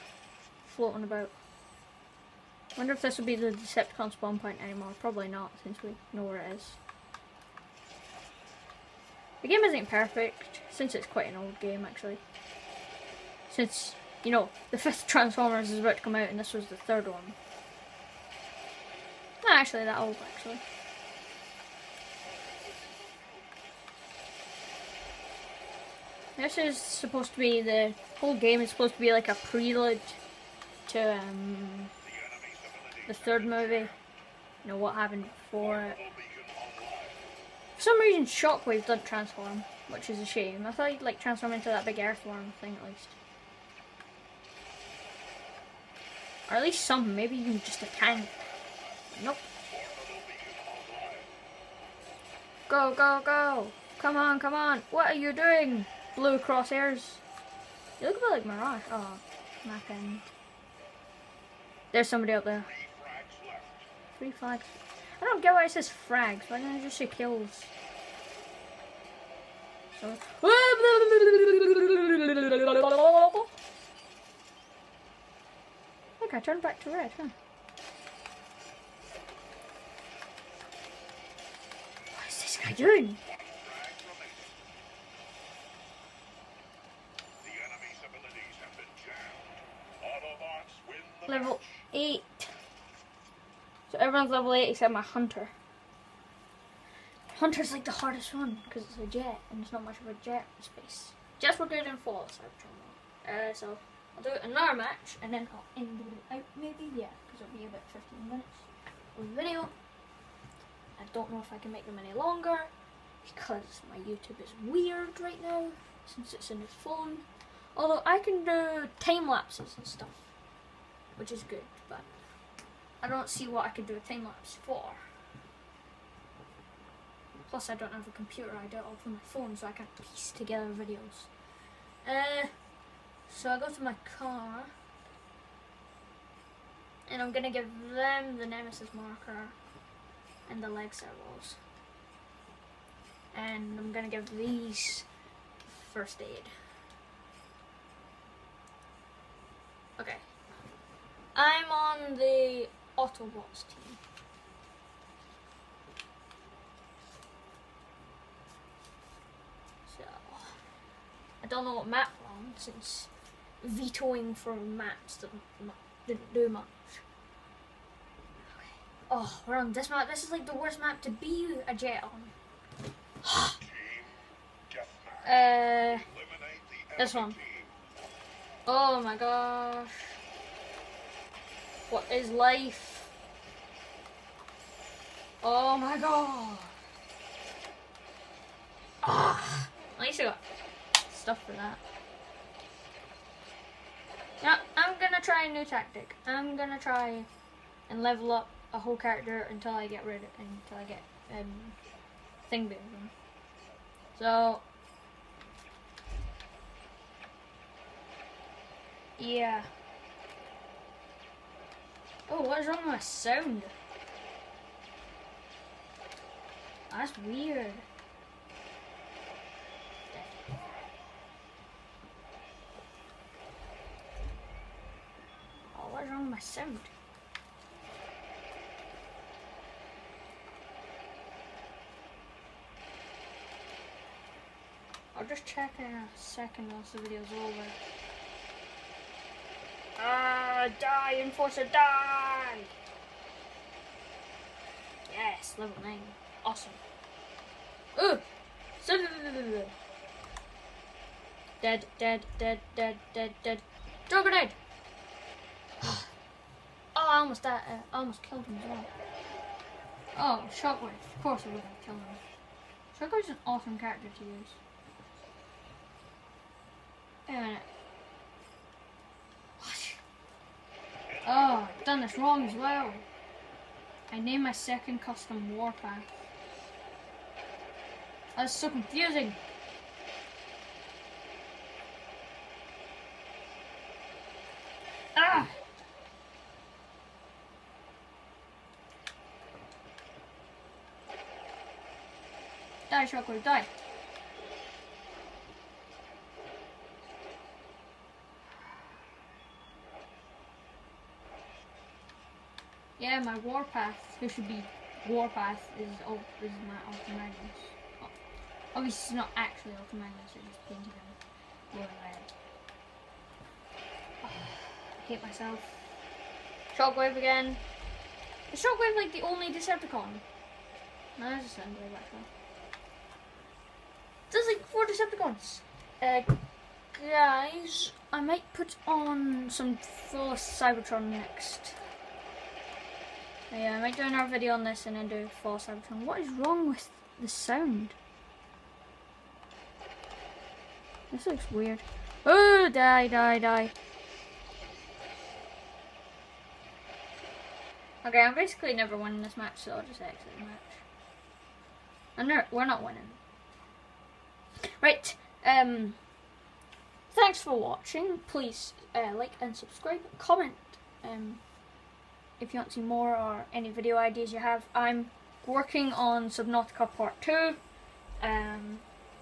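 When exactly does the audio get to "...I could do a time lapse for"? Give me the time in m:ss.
2:03.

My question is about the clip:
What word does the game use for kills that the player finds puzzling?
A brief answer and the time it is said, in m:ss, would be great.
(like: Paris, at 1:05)
frags, at 1:06.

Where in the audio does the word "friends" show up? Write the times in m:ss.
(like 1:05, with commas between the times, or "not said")
not said.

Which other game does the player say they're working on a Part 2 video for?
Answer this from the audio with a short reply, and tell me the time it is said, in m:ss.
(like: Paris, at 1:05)
Subnautica, at 6:06.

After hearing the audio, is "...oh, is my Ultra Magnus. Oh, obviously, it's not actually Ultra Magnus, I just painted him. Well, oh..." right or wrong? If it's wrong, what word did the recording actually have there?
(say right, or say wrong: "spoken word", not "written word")
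right.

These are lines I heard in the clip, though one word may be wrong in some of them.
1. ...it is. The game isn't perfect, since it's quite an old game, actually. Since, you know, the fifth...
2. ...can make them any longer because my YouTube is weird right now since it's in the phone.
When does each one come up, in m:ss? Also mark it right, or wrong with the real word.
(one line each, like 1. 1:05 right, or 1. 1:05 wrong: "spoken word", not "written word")
1. 0:06 right
2. 1:51 right.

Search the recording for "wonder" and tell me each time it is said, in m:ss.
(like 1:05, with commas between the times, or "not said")
0:02.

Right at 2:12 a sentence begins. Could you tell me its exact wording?
Uh, so I go to my car and I'm gonna give them the nemesis marker and the leg servos.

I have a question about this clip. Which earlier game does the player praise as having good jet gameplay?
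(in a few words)
Fall of Cybertron.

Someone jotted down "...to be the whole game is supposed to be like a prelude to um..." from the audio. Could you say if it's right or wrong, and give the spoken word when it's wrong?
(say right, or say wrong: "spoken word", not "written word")
right.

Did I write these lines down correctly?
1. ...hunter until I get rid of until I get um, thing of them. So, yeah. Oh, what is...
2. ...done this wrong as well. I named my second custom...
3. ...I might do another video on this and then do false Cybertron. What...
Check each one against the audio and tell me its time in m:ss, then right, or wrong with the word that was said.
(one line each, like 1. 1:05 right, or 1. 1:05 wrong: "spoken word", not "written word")
1. 3:18 wrong: "character", not "hunter"
2. 4:31 right
3. 5:33 right.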